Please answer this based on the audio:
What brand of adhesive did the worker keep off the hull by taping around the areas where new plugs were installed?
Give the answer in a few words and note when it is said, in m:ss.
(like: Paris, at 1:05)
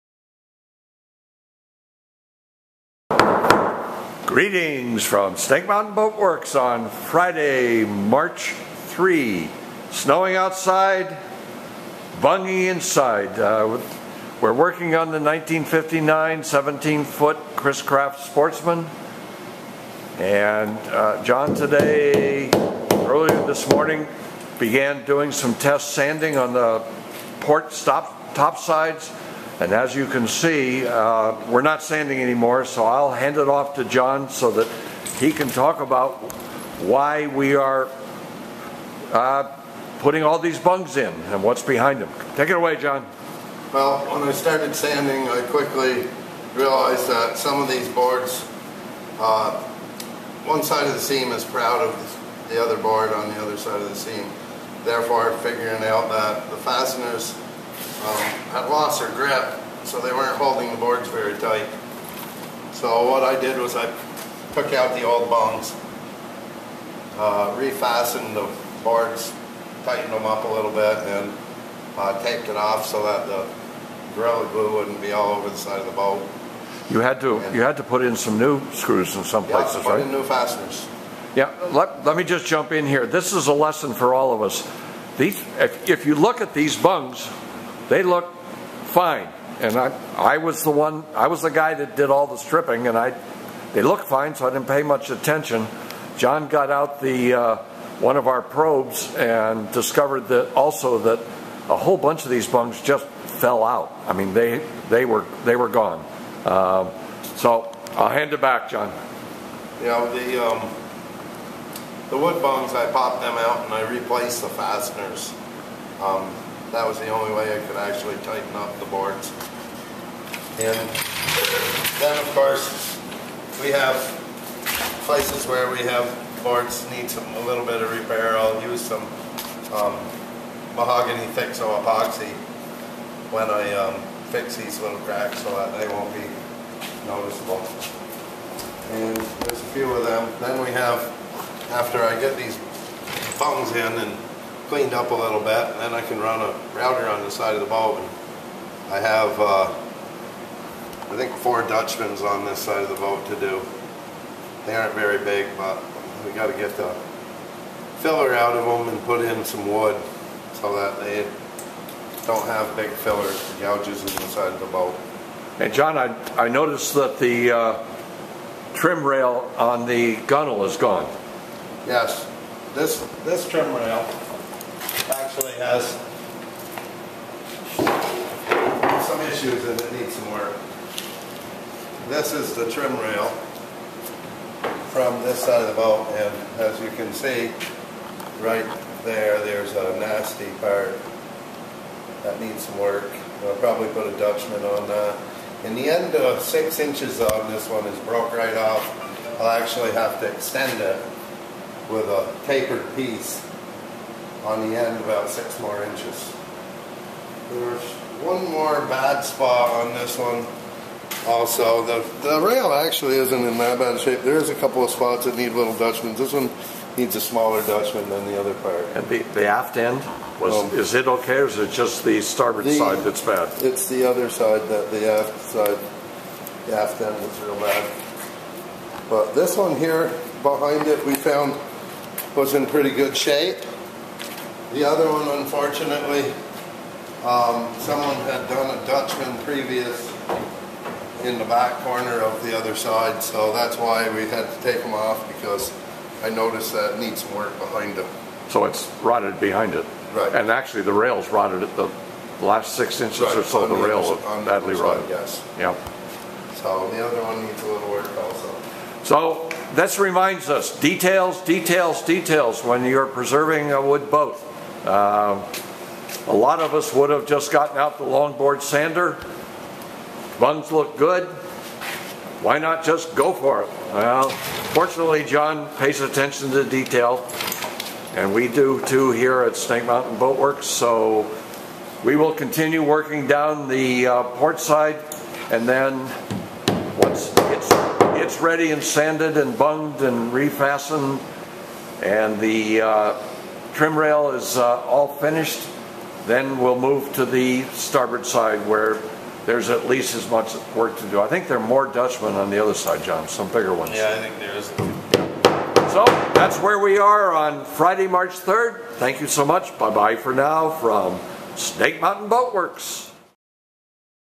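Gorilla Glue, at 1:14.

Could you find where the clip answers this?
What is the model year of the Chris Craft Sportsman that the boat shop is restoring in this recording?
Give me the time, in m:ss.
0:15.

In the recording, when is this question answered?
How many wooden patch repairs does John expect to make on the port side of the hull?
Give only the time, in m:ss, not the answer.
2:31.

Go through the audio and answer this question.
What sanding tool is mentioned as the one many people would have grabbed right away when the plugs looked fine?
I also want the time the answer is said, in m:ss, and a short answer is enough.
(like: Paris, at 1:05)
longboard sander, at 4:28.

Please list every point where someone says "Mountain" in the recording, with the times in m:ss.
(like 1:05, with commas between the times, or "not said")
0:05, 4:39, 5:11.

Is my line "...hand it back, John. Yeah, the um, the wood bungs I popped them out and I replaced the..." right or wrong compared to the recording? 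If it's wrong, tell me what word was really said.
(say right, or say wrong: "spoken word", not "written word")
right.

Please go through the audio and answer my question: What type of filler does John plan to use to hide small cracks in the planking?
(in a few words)
mahogany thick epoxy.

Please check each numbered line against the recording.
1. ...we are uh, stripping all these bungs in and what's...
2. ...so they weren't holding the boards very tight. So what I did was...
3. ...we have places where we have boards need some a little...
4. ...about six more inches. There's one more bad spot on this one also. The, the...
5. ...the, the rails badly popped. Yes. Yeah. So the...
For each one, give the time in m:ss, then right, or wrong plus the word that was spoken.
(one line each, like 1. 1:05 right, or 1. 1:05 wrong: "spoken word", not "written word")
1. 0:37 wrong: "putting", not "stripping"
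2. 0:59 right
3. 2:03 right
4. 3:25 right
5. 4:13 wrong: "rotted", not "popped".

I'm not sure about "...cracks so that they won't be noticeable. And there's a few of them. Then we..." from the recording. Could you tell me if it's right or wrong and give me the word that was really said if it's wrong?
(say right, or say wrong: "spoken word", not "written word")
right.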